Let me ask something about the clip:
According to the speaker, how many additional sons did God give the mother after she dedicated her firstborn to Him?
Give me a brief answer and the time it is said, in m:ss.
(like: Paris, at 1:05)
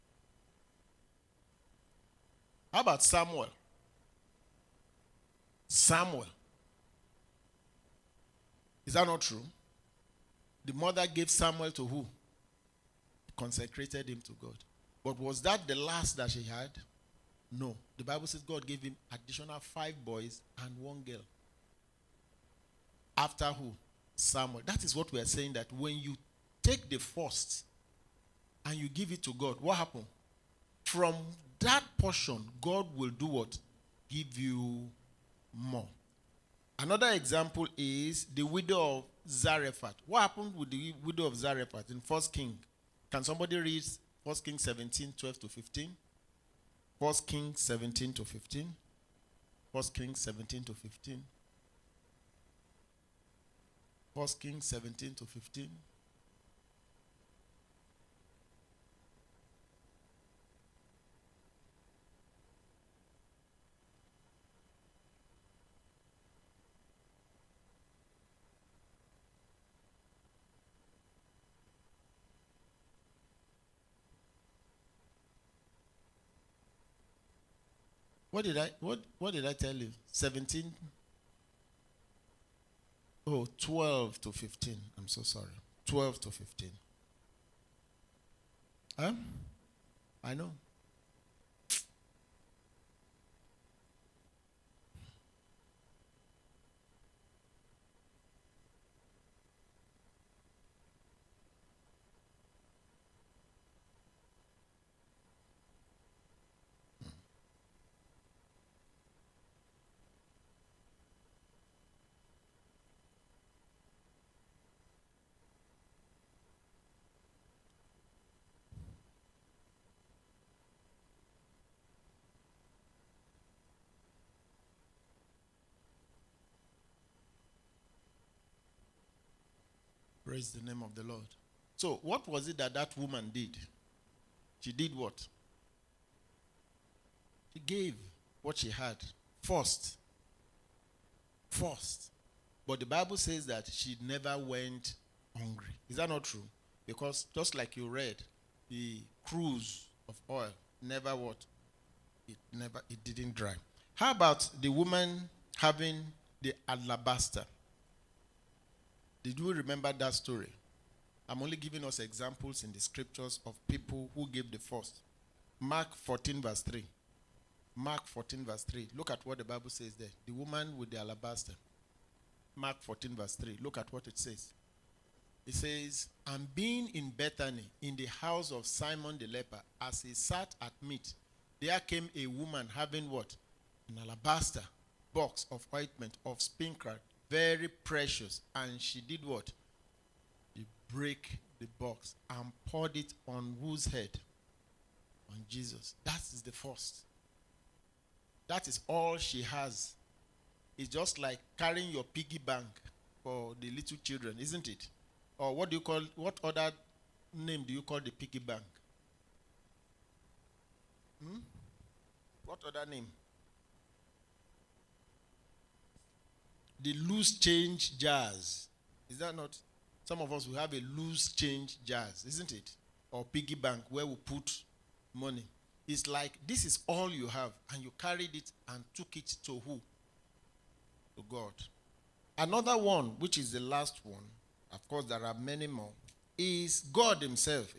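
5, at 0:19.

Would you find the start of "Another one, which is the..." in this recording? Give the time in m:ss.
3:52.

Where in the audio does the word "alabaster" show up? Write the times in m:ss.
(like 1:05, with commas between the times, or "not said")
2:36, 2:50, 3:04.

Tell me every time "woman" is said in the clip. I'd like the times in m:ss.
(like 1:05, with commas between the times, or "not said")
2:12, 2:34, 2:50, 3:02.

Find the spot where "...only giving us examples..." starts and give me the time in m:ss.
2:41.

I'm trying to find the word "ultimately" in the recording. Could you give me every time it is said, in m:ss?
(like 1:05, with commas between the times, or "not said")
not said.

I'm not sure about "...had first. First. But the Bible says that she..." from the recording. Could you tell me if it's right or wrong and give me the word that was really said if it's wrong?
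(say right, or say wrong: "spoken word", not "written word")
right.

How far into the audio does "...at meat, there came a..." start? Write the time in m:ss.
3:00.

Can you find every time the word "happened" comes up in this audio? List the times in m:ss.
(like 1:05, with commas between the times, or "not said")
0:29, 0:40.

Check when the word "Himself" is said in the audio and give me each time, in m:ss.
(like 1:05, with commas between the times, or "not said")
3:57.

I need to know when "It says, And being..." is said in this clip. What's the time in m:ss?
2:55.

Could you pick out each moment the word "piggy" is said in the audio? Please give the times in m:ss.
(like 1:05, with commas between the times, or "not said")
3:22, 3:28, 3:43.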